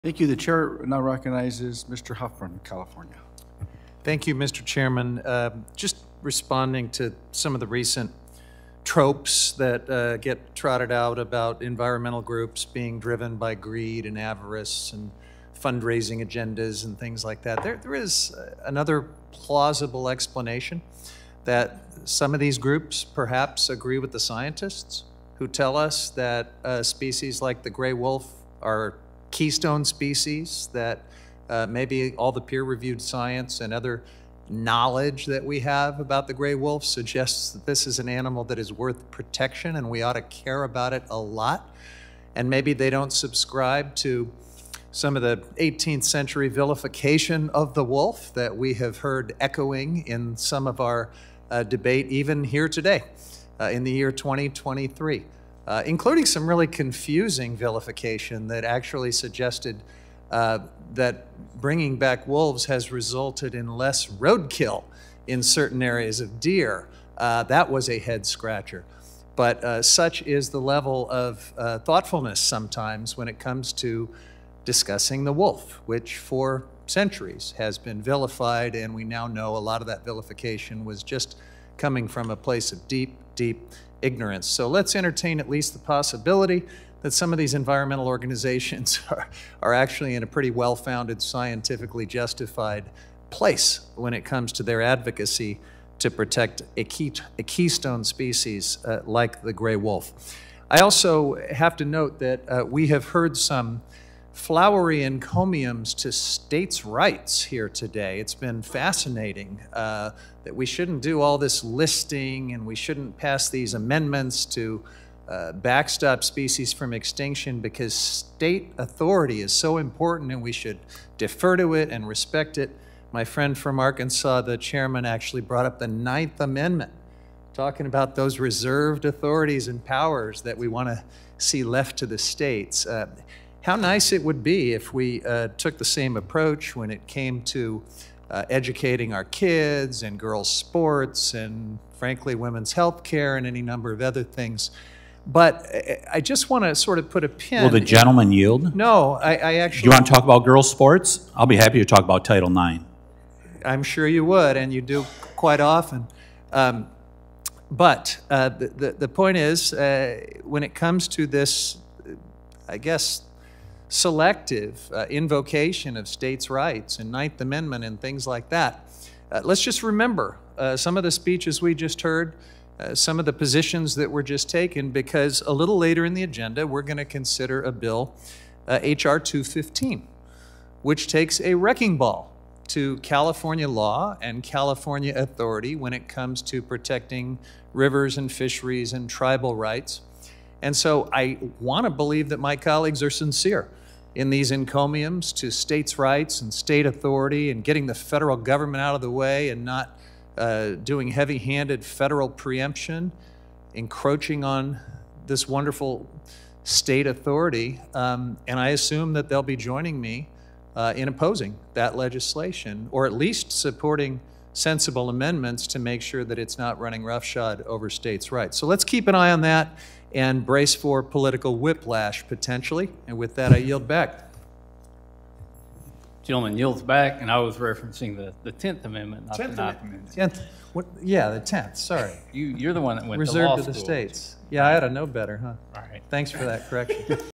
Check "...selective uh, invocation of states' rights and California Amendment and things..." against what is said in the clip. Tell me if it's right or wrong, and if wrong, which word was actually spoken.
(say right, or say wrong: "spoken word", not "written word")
wrong: "Ninth", not "California".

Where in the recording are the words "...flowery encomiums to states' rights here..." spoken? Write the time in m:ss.
1:44.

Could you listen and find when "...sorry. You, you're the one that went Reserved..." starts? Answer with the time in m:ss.
3:51.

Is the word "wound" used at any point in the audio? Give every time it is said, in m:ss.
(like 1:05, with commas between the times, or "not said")
not said.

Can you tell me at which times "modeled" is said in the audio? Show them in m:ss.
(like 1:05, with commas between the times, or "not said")
not said.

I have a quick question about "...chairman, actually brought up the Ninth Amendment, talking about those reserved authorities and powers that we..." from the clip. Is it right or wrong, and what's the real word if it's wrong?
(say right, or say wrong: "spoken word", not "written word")
right.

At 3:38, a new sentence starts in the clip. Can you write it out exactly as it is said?
So let's keep an eye on that and brace for political whiplash potentially.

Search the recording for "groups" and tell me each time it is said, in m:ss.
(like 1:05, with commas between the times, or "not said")
0:12, 0:22.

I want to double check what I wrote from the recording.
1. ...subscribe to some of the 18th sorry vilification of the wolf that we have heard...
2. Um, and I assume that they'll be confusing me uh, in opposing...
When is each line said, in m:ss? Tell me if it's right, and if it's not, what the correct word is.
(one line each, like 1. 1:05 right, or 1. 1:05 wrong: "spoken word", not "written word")
1. 0:43 wrong: "century", not "sorry"
2. 3:27 wrong: "joining", not "confusing".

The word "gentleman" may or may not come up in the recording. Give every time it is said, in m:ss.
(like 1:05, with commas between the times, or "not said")
2:27, 3:46.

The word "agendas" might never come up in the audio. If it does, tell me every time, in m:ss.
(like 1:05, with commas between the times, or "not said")
0:16, 2:56.